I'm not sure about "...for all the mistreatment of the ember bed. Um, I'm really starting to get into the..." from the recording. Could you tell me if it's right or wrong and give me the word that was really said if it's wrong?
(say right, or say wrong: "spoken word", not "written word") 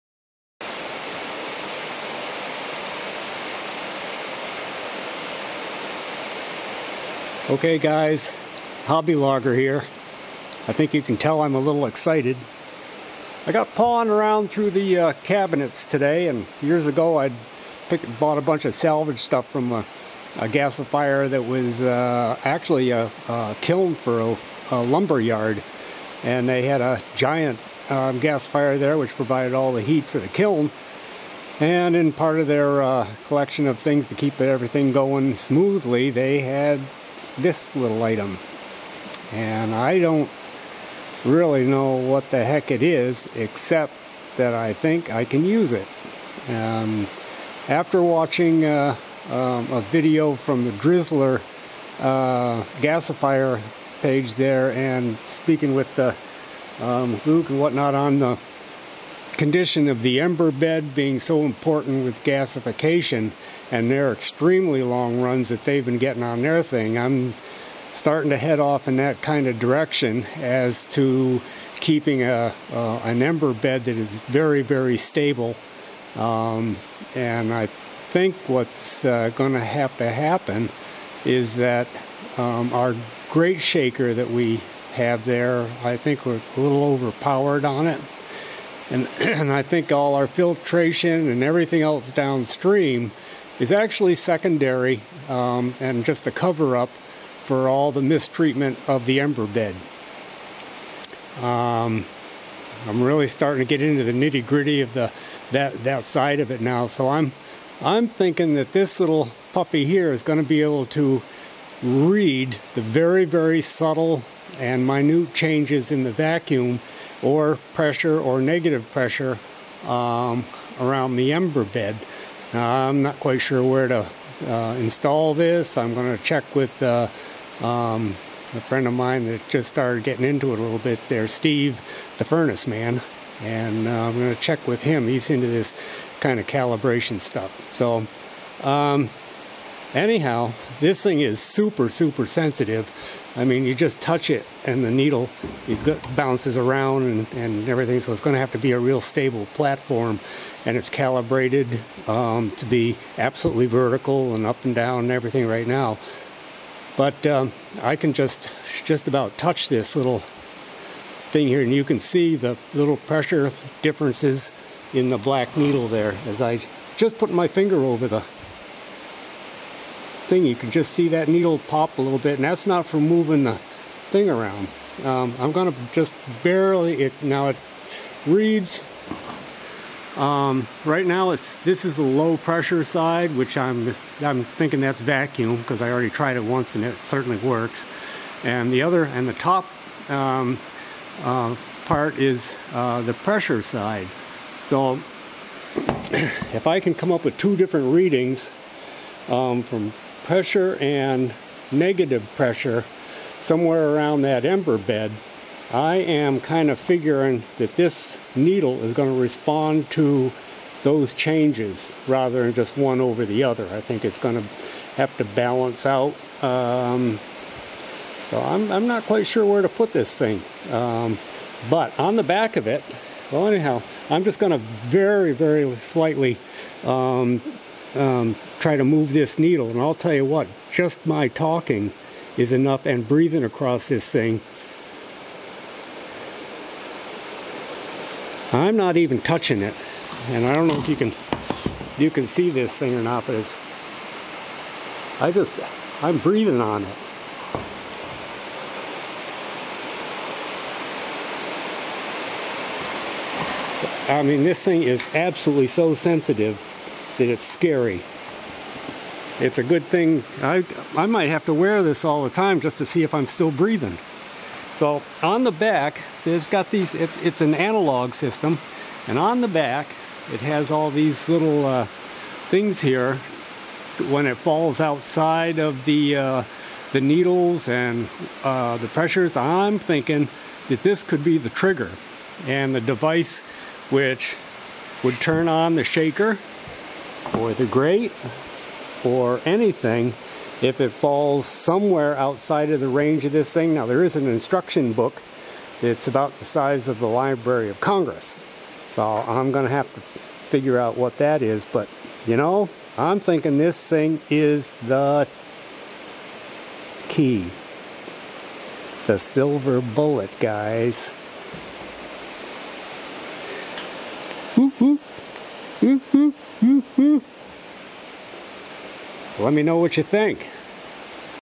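right.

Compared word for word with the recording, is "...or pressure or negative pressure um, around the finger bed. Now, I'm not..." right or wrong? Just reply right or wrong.
wrong.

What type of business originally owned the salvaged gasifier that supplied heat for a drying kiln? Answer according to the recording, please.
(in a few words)
Lumber yard.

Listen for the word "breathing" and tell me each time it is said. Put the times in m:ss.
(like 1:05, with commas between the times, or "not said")
3:53, 4:06, 4:23.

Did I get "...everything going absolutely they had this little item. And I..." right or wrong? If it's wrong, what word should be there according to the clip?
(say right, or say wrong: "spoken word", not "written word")
wrong: "smoothly", not "absolutely".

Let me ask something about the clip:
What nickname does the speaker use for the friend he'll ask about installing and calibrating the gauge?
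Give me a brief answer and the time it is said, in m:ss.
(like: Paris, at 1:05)
Steve, the furnace man, at 2:11.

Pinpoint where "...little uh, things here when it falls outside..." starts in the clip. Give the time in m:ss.
4:31.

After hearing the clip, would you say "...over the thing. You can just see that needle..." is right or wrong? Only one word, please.
right.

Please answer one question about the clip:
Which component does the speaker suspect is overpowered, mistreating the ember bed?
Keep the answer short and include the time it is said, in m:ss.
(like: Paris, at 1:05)
Grate shaker, at 1:23.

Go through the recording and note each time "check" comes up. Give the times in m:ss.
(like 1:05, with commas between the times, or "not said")
2:06, 2:14.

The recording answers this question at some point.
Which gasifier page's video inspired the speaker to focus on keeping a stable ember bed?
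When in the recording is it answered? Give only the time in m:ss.
0:50.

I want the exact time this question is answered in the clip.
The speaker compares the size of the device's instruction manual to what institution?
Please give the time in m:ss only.
4:57.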